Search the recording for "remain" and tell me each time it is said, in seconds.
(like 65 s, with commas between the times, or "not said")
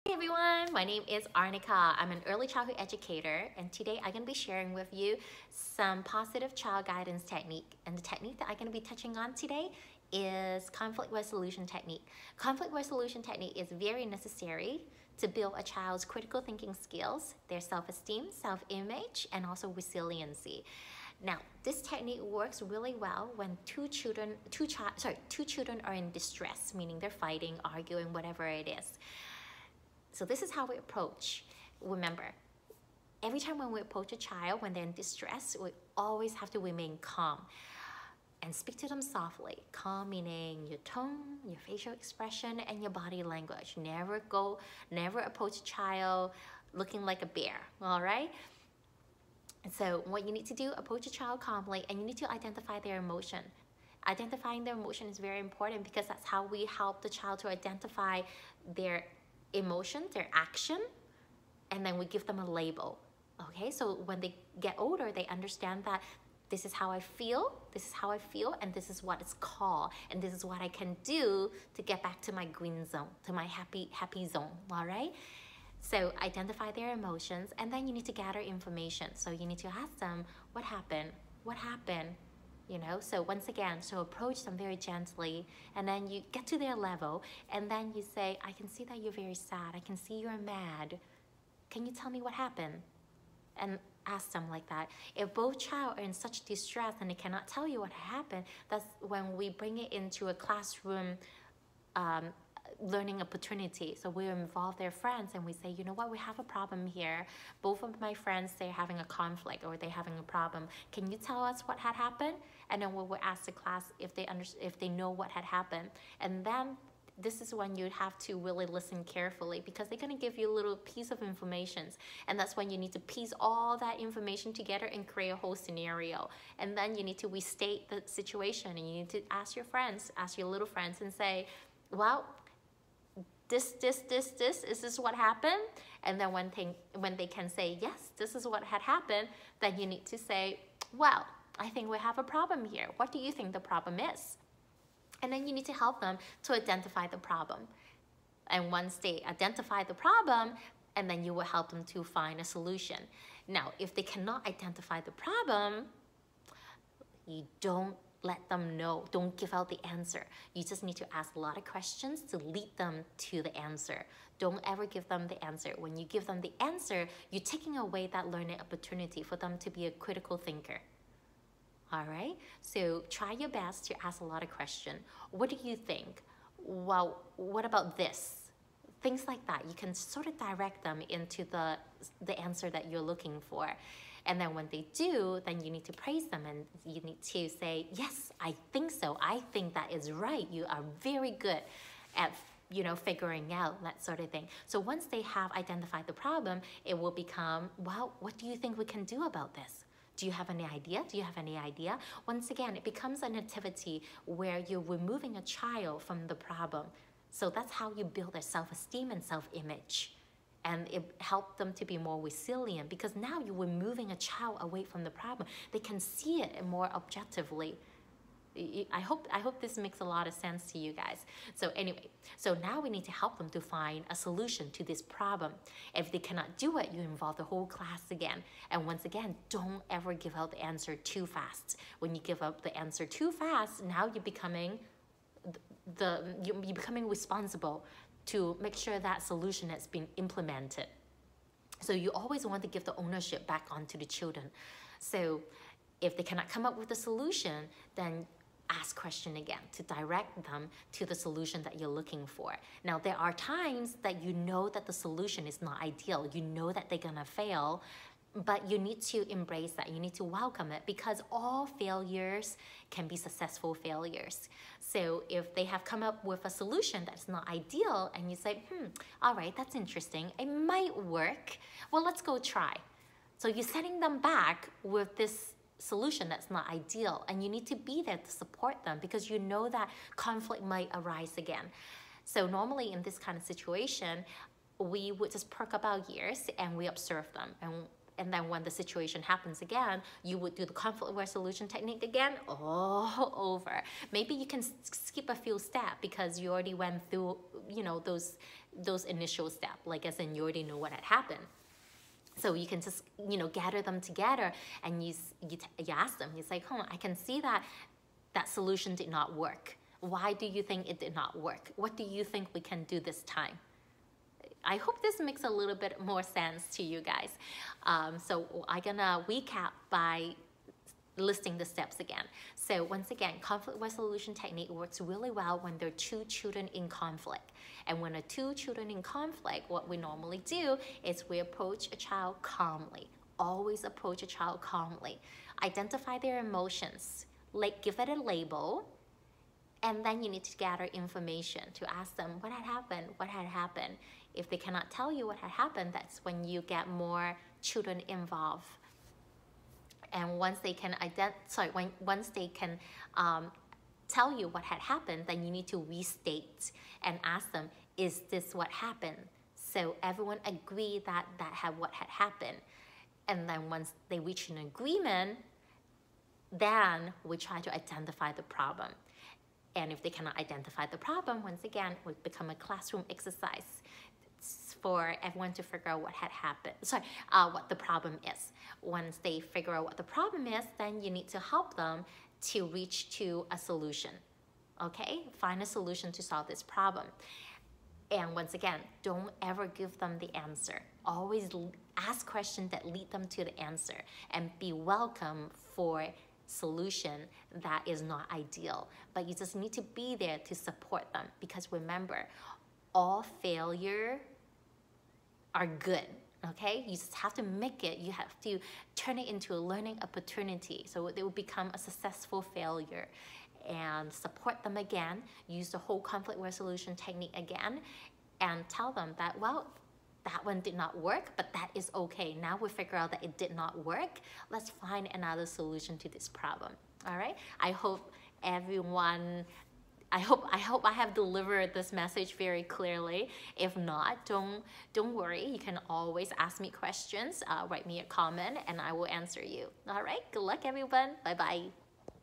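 36 s.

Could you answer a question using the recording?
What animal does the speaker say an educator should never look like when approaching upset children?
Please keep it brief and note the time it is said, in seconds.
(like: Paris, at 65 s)
A bear, at 47 s.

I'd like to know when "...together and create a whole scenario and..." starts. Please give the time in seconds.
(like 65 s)
124 s.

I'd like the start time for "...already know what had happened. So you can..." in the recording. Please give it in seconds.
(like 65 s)
300 s.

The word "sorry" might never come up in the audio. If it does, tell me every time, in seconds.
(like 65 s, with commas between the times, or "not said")
24 s, 351 s, 376 s.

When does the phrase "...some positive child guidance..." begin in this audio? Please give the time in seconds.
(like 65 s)
5 s.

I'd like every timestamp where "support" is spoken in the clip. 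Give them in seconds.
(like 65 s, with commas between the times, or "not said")
278 s, 400 s, 414 s.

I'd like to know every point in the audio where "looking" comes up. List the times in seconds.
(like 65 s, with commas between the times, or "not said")
46 s, 183 s, 251 s.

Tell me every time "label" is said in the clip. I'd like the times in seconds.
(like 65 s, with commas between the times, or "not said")
62 s, 338 s.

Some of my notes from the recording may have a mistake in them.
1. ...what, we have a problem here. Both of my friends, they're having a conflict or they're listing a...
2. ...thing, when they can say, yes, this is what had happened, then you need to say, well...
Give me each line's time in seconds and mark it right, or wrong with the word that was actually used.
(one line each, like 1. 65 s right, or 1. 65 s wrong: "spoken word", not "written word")
1. 105 s wrong: "having", not "listing"
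2. 136 s right.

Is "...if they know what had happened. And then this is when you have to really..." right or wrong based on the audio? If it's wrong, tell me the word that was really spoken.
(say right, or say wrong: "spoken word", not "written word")
right.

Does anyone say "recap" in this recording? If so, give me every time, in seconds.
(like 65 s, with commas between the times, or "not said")
319 s.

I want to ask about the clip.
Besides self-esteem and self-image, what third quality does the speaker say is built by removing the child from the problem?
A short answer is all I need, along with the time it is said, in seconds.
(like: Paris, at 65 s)
Resilient, at 212 s.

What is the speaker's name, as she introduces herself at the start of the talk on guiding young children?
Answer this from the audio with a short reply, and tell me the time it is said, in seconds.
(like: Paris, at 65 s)
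Arnica, at 1 s.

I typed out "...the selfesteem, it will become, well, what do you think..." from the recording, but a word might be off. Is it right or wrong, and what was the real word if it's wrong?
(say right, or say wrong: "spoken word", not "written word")
wrong: "problem", not "selfesteem".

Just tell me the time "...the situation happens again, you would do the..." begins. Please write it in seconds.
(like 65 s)
288 s.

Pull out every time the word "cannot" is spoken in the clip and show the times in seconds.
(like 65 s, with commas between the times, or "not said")
97 s, 154 s, 226 s, 246 s, 344 s, 370 s.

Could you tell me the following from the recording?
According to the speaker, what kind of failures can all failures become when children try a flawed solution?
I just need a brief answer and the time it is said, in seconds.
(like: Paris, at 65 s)
Successful failures, at 263 s.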